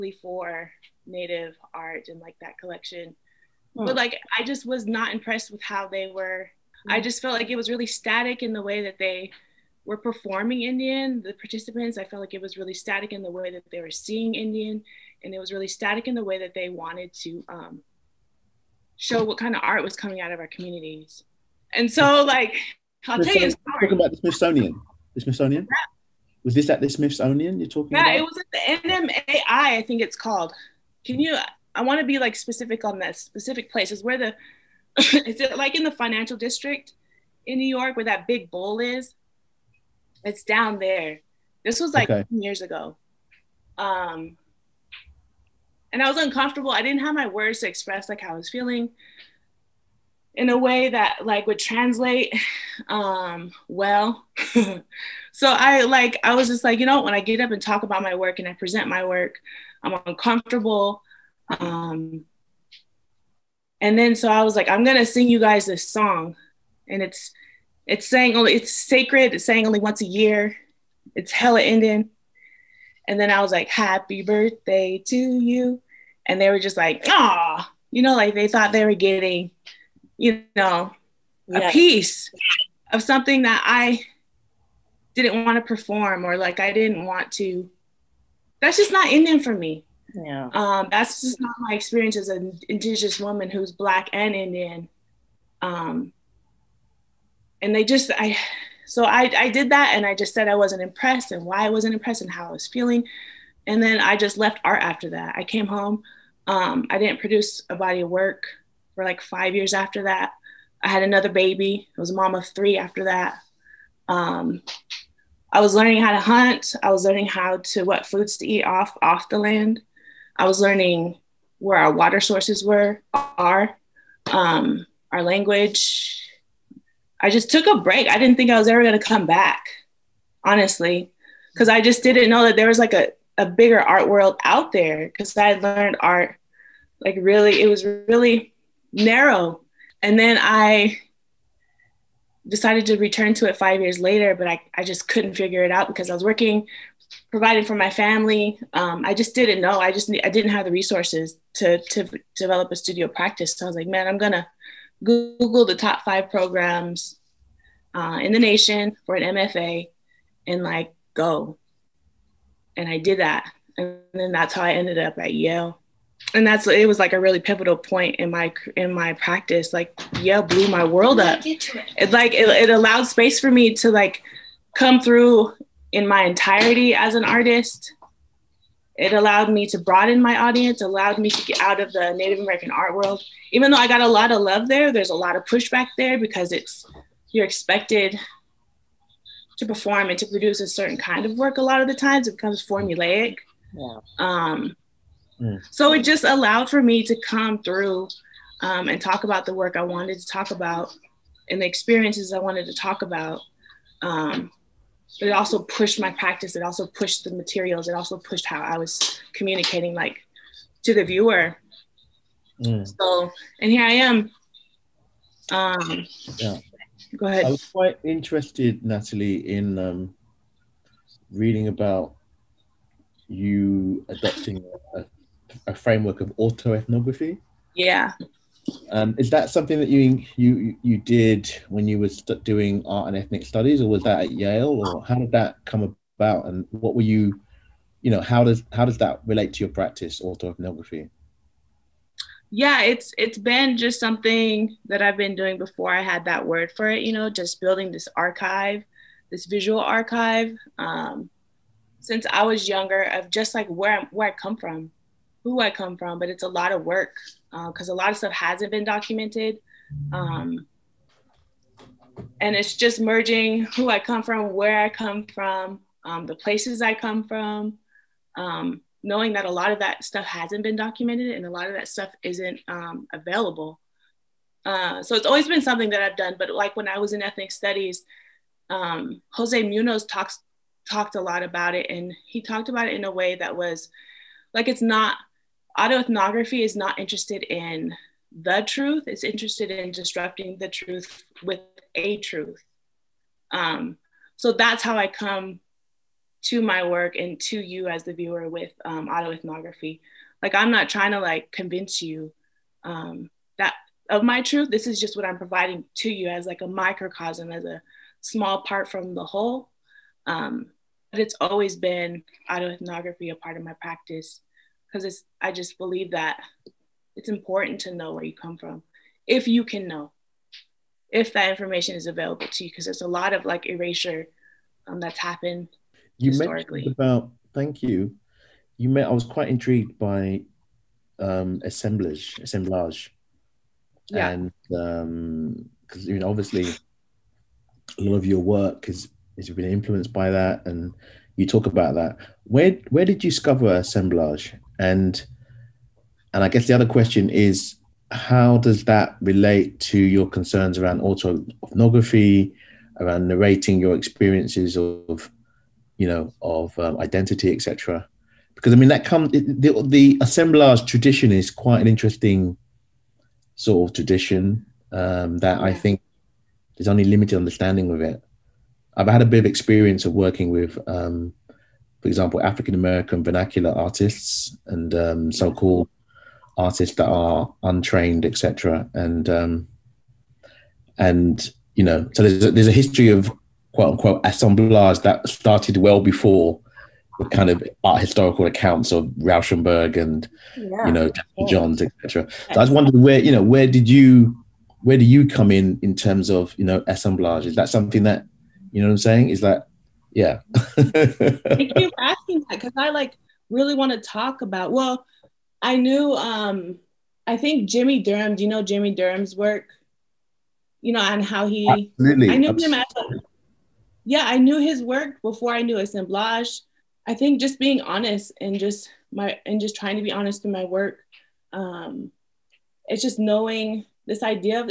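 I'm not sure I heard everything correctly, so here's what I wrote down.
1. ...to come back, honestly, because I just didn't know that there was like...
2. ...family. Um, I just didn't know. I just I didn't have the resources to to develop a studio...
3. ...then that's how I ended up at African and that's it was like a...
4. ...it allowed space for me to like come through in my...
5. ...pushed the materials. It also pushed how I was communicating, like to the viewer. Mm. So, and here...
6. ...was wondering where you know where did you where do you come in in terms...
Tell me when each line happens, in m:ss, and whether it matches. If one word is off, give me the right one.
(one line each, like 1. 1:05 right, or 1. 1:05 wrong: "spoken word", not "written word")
1. 2:08 right
2. 2:27 right
3. 2:44 wrong: "Yale", not "African"
4. 2:52 right
5. 3:26 right
6. 6:32 right.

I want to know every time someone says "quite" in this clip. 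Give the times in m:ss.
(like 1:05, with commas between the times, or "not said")
3:37, 5:29, 6:01.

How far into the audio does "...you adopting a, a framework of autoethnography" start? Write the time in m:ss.
3:43.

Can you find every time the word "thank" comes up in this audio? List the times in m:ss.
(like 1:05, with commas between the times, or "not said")
5:27, 6:40.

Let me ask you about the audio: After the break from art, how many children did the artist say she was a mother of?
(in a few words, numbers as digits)
3.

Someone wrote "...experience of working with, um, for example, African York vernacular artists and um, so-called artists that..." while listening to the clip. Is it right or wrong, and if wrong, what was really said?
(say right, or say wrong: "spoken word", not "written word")
wrong: "American", not "York".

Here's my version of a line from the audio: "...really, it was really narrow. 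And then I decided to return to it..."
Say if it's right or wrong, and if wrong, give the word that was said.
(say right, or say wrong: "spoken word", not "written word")
right.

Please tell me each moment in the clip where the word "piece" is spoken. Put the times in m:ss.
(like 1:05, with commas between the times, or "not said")
1:21.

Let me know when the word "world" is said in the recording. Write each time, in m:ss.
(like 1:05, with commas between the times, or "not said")
2:14, 2:50, 3:02.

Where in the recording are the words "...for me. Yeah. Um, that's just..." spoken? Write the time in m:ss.
1:29.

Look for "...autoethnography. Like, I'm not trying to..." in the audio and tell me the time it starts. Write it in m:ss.
4:59.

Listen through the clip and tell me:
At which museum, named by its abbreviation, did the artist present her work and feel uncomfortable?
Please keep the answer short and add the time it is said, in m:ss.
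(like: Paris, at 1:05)
NMAI, at 0:28.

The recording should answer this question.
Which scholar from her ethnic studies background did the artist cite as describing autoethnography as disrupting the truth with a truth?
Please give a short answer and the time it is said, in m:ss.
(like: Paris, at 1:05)
Jose Munoz, at 4:39.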